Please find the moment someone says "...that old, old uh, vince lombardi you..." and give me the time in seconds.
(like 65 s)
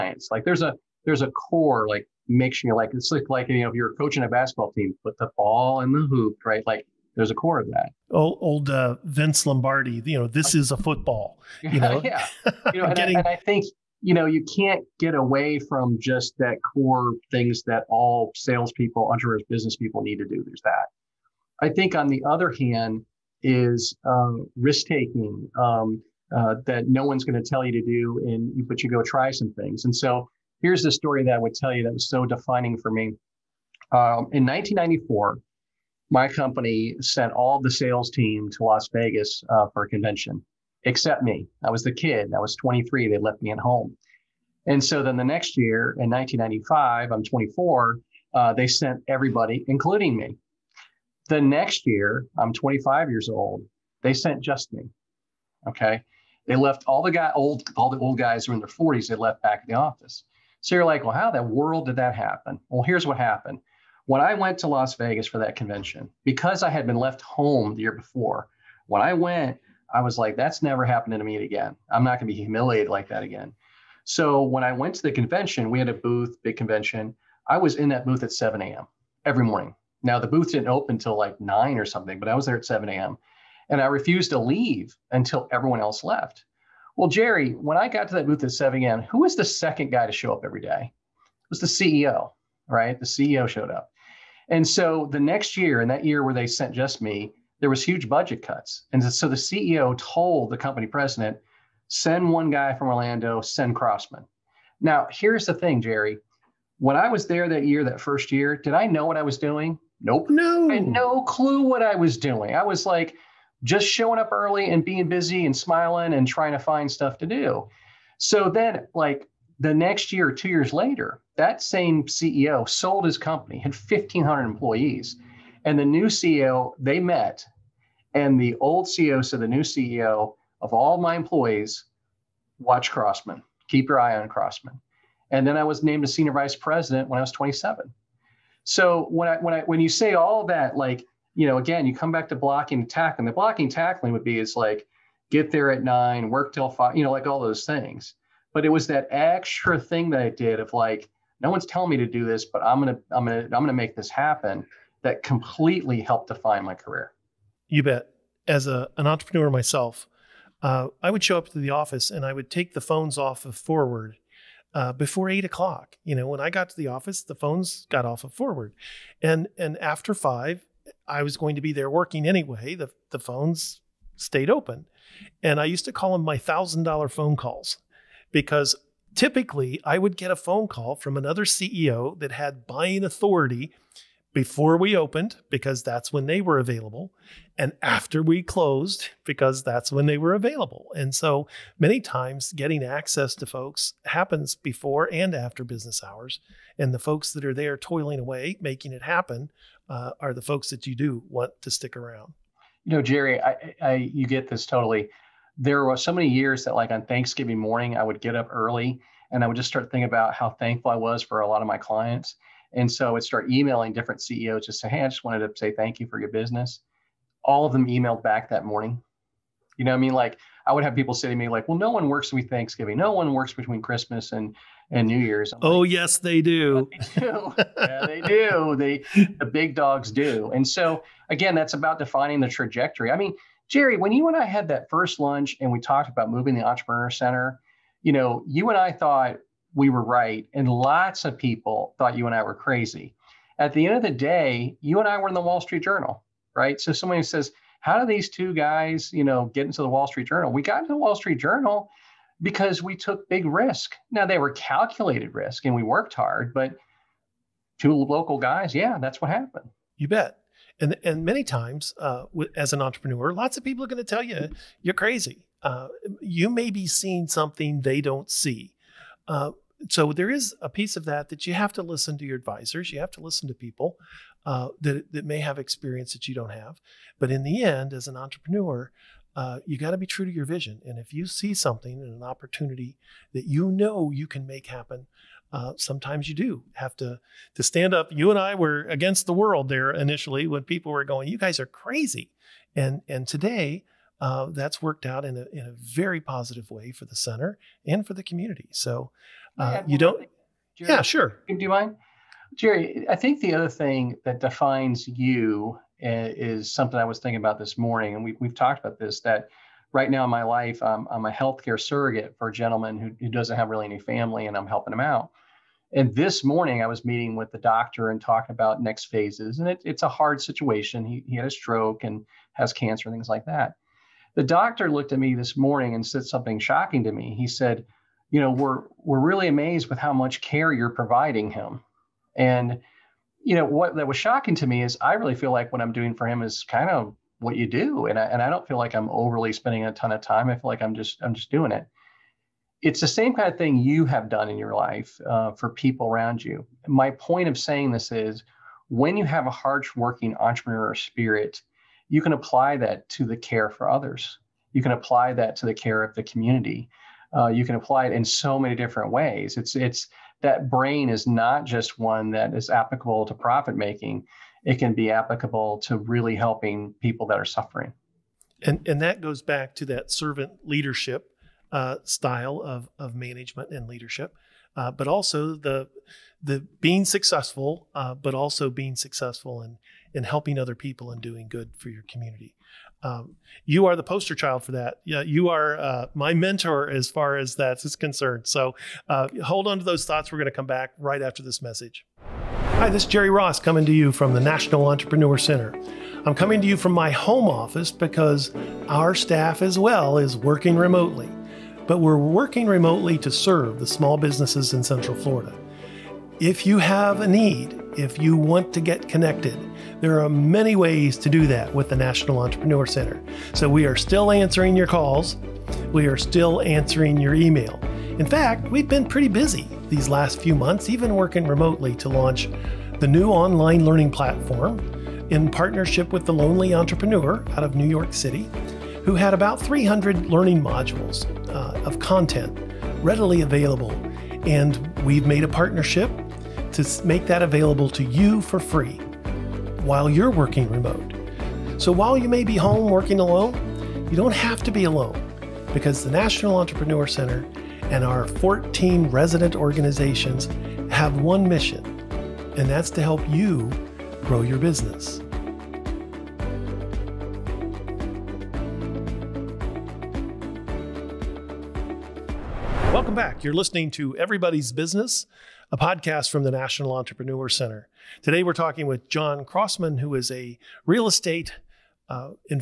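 7 s.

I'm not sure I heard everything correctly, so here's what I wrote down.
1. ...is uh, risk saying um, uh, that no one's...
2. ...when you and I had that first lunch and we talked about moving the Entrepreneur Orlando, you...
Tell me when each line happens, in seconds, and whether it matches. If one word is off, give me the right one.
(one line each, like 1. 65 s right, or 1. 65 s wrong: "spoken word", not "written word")
1. 23 s wrong: "taking", not "saying"
2. 233 s wrong: "Center", not "Orlando".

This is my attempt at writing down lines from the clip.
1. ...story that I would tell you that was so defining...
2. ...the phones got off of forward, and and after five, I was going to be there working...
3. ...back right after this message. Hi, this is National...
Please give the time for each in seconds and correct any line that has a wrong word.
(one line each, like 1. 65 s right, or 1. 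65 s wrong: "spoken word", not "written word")
1. 30 s right
2. 167 s right
3. 390 s wrong: "Jerry", not "National".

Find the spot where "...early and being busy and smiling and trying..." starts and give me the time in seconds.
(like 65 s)
114 s.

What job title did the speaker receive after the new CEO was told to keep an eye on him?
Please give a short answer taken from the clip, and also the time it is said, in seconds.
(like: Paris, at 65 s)
senior vice president, at 136 s.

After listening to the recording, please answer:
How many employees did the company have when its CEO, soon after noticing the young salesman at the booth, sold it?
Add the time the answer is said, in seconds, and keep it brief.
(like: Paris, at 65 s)
1,500, at 123 s.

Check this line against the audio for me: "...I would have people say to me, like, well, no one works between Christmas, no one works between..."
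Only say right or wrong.
wrong.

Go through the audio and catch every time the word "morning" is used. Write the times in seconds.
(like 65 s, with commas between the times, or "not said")
79 s, 207 s, 218 s, 307 s, 316 s, 325 s.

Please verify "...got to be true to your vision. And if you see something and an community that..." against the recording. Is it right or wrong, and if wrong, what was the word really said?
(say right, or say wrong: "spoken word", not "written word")
wrong: "opportunity", not "community".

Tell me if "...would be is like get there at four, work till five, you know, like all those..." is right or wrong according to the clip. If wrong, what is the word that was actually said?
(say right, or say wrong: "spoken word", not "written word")
wrong: "nine", not "four".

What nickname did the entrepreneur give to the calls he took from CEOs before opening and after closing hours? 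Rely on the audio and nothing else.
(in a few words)
thousand dollar phone calls.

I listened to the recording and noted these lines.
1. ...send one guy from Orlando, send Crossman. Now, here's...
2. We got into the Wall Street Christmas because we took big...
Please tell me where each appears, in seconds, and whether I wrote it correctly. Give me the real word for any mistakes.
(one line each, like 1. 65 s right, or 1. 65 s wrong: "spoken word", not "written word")
1. 101 s right
2. 250 s wrong: "Journal", not "Christmas".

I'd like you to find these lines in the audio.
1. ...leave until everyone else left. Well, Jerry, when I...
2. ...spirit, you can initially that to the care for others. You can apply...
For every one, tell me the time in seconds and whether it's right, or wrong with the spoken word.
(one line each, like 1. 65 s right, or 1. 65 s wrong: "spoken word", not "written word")
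1. 84 s right
2. 350 s wrong: "apply", not "initially".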